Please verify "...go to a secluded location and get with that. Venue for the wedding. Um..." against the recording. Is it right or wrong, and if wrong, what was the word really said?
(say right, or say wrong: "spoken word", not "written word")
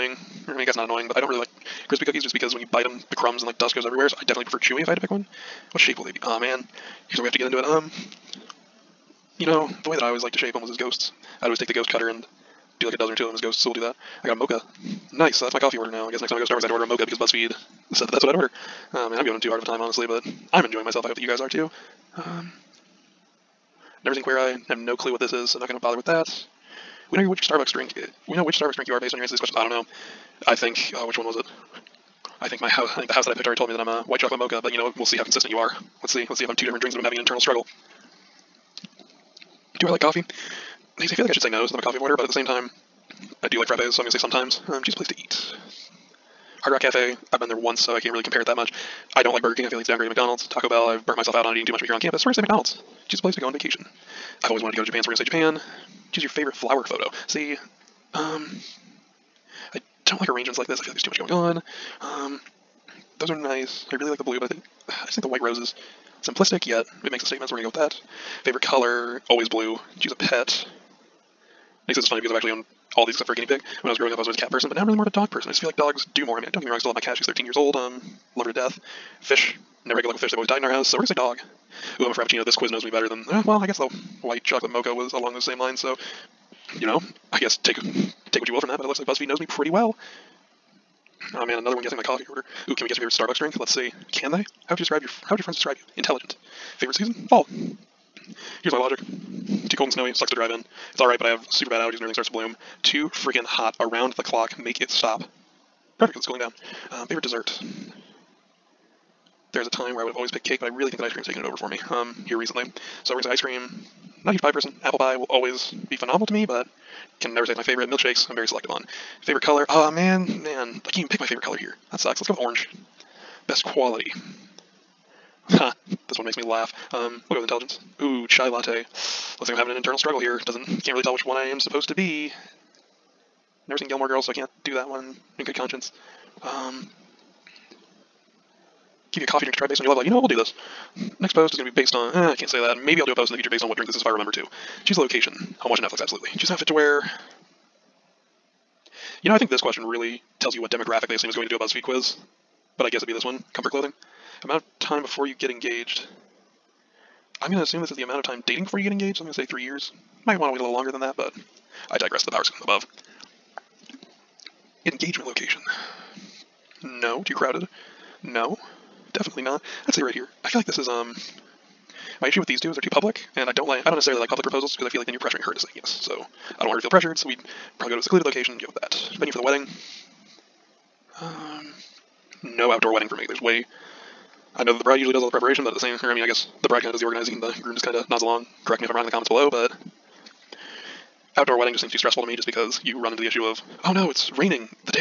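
right.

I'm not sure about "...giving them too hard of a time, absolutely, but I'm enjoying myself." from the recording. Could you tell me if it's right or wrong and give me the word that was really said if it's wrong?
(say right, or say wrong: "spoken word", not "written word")
wrong: "honestly", not "absolutely".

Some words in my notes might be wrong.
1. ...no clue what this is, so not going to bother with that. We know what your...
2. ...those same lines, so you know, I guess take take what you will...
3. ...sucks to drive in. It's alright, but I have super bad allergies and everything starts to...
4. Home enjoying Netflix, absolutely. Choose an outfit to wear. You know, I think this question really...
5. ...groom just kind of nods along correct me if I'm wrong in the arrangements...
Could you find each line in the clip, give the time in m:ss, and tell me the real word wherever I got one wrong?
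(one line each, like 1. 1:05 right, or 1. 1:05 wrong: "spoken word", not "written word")
1. 0:24 right
2. 1:25 right
3. 1:40 right
4. 2:25 wrong: "watching", not "enjoying"
5. 3:07 wrong: "comments", not "arrangements".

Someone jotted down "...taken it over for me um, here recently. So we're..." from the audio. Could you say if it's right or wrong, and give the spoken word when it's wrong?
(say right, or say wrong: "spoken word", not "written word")
right.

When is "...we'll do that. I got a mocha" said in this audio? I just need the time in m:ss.
0:13.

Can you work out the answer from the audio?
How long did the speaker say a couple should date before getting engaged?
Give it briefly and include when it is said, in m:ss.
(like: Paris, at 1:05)
3 years, at 2:39.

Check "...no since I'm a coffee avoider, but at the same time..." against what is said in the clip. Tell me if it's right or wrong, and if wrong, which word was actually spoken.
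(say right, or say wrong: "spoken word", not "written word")
right.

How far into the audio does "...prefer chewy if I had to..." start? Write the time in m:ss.
0:04.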